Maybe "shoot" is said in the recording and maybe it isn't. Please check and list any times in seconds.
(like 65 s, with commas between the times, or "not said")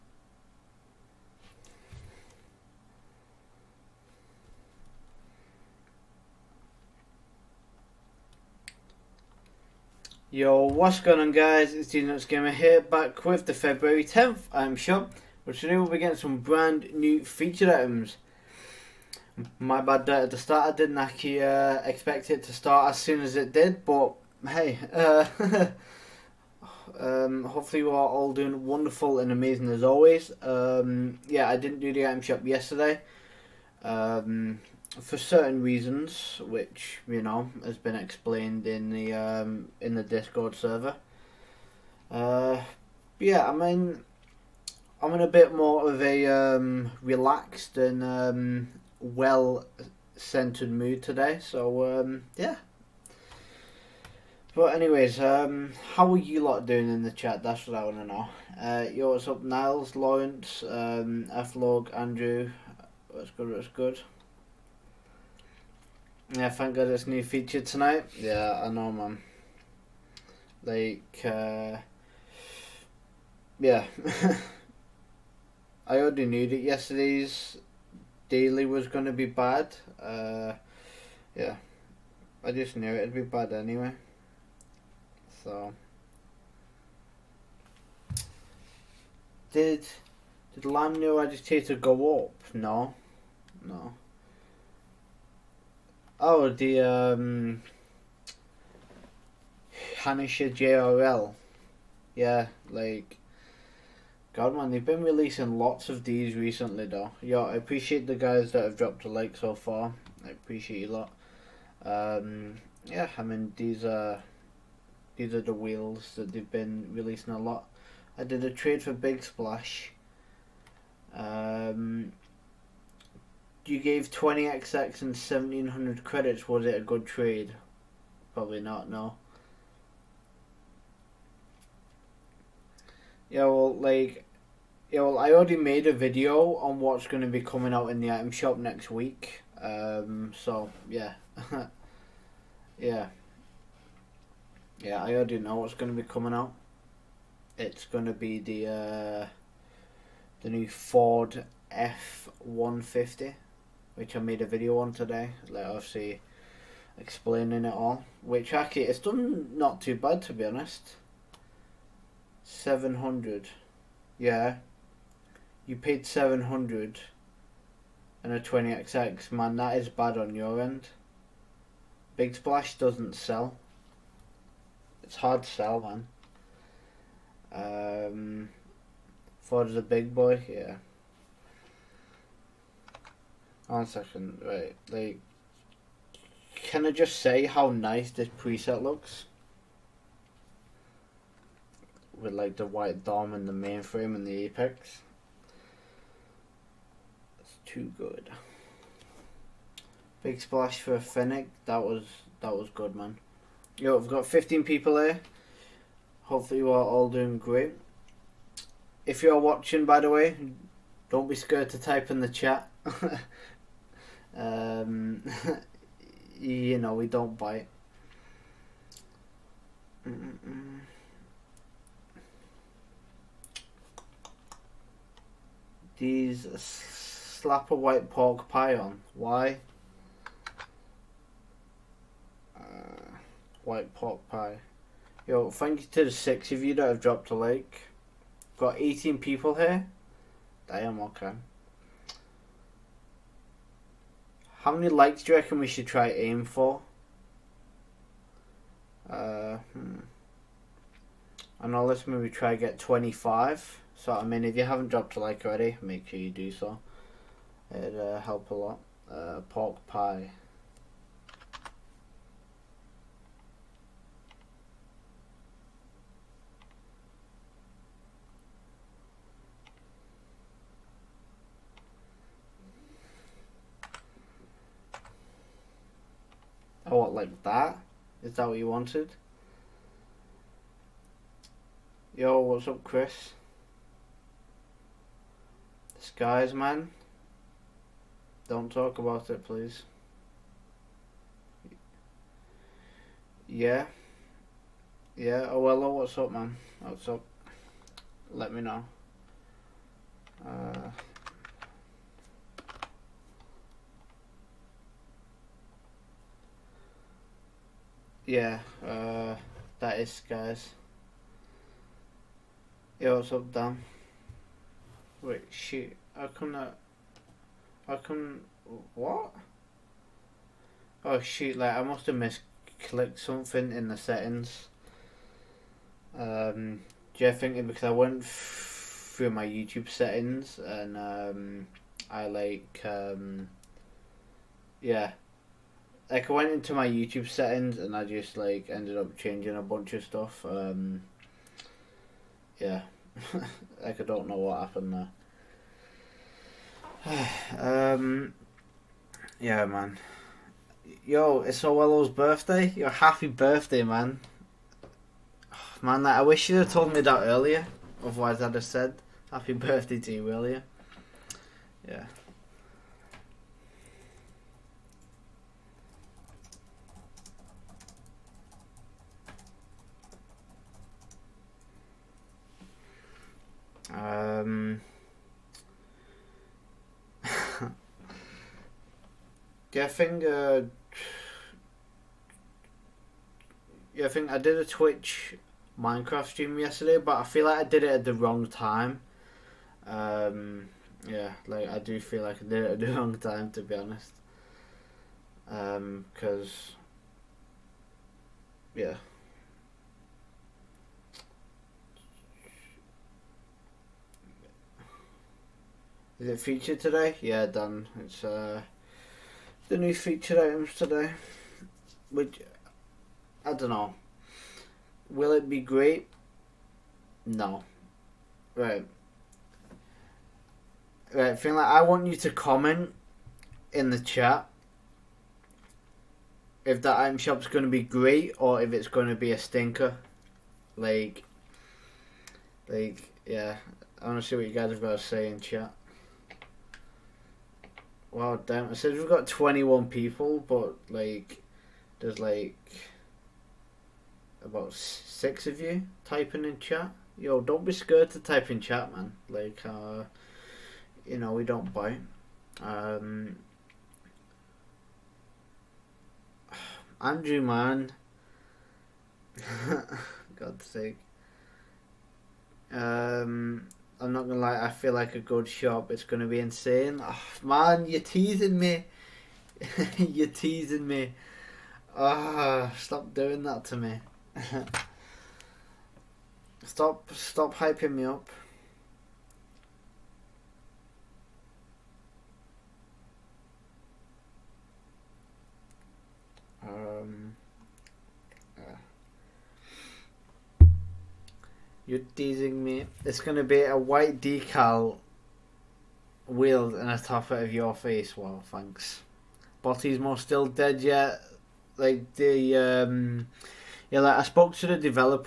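315 s, 321 s.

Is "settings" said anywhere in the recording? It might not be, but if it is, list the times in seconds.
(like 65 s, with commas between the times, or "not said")
323 s, 329 s, 337 s.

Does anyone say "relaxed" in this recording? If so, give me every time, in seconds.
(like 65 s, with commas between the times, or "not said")
47 s.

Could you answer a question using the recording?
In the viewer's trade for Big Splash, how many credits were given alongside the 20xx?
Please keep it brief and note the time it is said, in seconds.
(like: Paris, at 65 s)
1700, at 125 s.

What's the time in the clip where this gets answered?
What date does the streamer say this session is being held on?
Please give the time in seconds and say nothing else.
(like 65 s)
13 s.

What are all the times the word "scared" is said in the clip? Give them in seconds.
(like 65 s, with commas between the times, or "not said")
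211 s, 447 s.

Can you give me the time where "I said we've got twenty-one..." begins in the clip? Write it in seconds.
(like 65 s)
438 s.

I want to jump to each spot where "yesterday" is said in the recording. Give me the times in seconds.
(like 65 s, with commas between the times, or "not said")
32 s, 76 s, 386 s.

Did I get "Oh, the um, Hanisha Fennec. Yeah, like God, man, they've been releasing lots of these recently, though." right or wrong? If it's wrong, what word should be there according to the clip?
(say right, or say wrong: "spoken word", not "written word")
wrong: "JRL", not "Fennec".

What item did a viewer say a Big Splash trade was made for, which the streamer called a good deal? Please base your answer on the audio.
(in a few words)
Fennec.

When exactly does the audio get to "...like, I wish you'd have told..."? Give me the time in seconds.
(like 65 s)
356 s.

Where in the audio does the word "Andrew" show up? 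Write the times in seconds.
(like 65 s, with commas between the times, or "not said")
61 s, 456 s.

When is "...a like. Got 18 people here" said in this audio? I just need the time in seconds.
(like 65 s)
237 s.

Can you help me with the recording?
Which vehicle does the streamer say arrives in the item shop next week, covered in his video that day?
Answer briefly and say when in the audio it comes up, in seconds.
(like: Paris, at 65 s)
Ford F-150, at 150 s.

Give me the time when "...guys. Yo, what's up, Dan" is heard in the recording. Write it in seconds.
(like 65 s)
310 s.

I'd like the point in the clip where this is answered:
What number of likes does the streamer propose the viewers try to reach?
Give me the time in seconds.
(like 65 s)
252 s.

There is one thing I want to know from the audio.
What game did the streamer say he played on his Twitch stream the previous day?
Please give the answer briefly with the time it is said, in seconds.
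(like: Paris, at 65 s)
Minecraft, at 385 s.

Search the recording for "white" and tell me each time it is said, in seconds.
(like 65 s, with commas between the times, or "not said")
192 s, 227 s, 233 s, 493 s.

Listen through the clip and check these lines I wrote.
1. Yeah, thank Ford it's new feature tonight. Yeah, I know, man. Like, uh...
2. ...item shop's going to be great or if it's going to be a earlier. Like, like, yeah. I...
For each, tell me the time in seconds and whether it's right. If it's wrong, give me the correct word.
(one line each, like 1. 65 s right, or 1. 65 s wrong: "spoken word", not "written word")
1. 66 s wrong: "God", not "Ford"
2. 426 s wrong: "stinker", not "earlier".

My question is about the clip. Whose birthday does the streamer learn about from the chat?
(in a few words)
Orwello.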